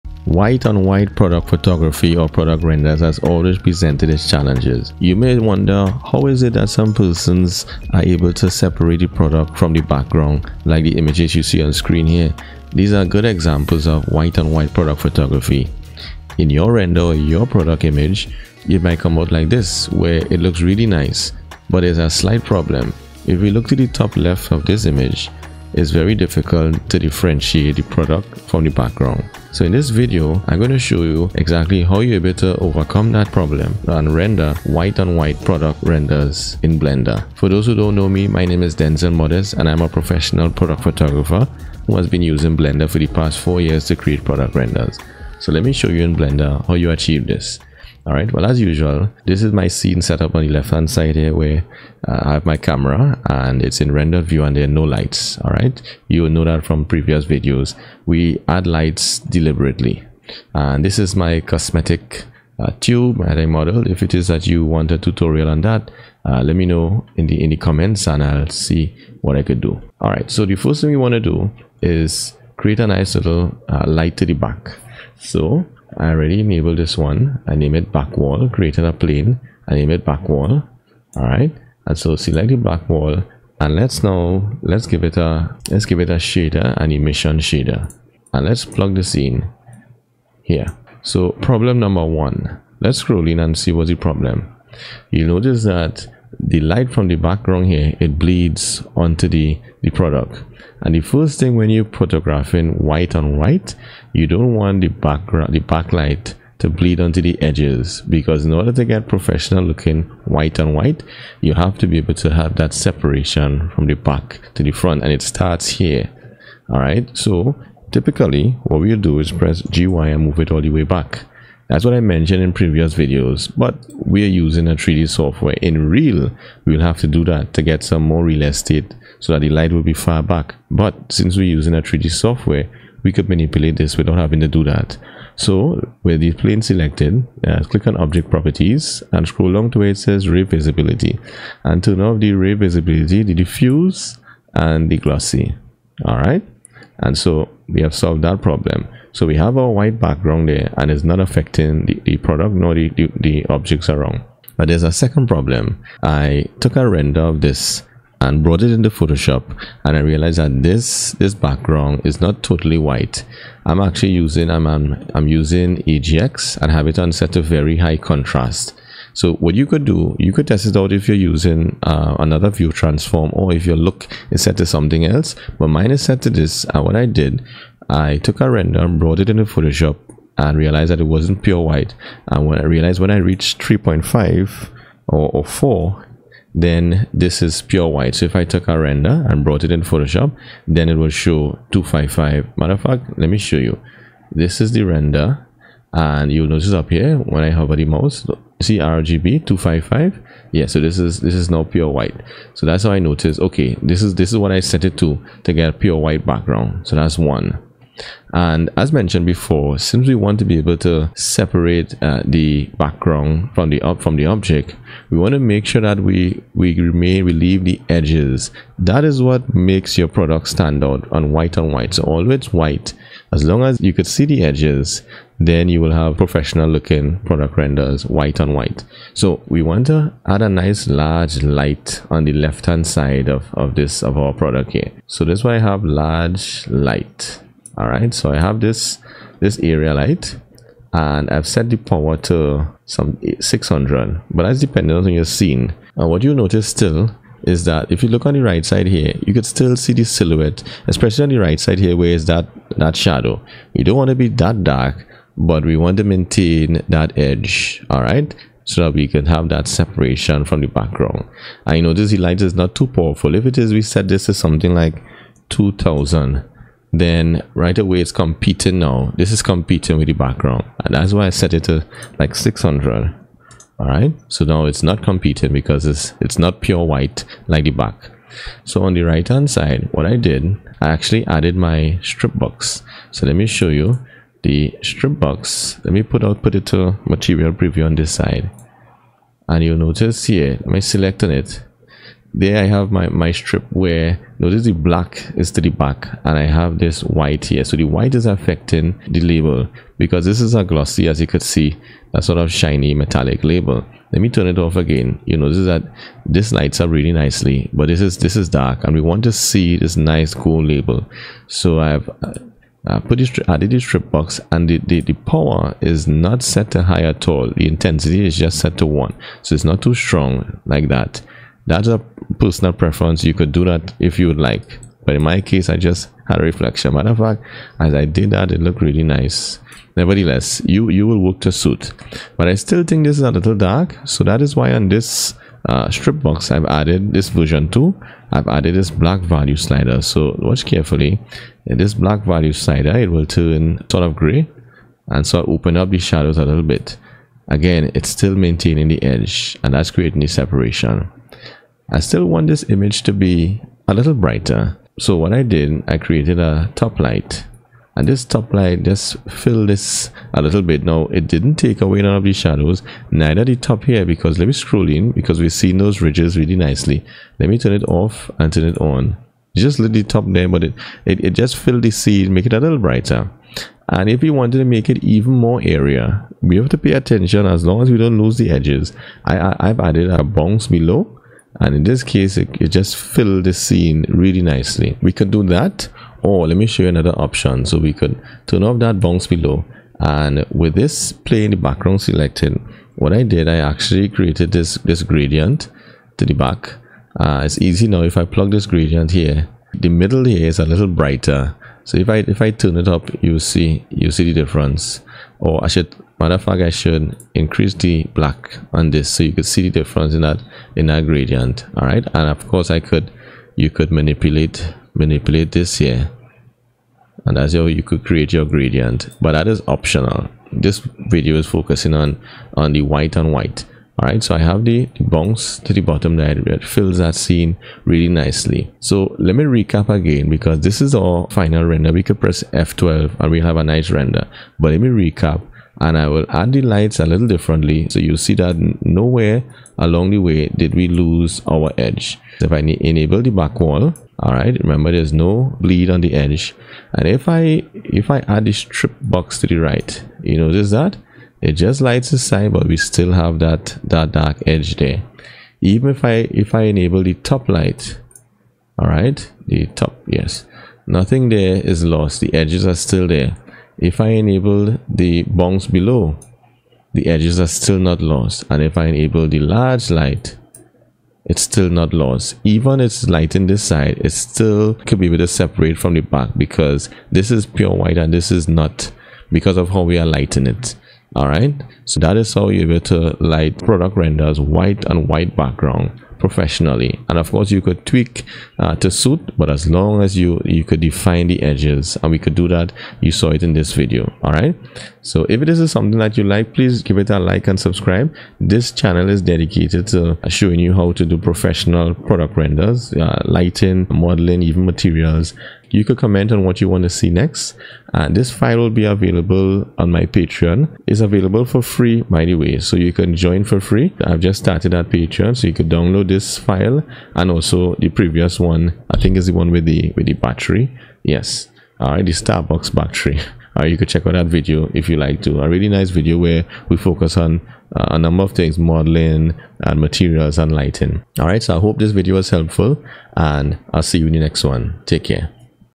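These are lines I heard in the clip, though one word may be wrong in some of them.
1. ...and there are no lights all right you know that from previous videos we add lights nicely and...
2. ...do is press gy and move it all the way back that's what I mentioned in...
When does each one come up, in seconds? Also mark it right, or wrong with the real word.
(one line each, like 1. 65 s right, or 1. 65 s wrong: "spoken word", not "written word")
1. 54 s wrong: "deliberately", not "nicely"
2. 118 s right.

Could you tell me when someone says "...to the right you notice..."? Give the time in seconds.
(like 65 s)
449 s.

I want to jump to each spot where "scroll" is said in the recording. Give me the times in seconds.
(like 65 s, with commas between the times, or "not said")
92 s, 139 s, 364 s.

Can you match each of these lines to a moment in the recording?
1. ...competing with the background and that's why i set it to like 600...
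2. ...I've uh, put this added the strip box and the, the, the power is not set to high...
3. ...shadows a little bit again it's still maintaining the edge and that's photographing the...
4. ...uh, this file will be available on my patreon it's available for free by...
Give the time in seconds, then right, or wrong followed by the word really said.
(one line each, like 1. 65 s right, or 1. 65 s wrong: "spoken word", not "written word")
1. 269 s right
2. 311 s right
3. 345 s wrong: "creating", not "photographing"
4. 508 s right.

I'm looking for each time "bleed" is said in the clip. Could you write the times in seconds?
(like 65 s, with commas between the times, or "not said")
98 s, 106 s, 445 s.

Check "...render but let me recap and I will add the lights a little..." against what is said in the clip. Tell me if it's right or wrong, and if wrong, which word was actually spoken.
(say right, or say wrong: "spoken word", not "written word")
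right.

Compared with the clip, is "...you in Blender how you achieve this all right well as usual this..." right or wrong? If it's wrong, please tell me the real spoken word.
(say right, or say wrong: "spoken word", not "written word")
right.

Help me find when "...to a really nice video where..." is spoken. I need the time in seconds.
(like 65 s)
525 s.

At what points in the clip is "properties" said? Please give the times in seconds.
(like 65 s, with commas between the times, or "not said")
138 s.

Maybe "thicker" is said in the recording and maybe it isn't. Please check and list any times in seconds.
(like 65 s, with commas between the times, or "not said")
not said.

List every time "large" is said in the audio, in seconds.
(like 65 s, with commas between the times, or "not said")
230 s, 235 s, 469 s.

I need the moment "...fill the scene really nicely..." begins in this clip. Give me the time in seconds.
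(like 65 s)
382 s.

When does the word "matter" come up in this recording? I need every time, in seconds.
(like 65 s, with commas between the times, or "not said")
192 s, 326 s, 406 s.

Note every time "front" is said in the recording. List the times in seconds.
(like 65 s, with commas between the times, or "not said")
114 s.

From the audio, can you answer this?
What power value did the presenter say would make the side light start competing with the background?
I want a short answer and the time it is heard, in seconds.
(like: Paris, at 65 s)
2000, at 265 s.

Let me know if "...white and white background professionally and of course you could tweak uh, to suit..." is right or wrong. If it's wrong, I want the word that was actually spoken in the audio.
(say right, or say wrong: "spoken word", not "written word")
right.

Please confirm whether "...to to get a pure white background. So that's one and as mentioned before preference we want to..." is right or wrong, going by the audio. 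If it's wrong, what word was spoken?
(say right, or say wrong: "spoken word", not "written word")
wrong: "since", not "preference".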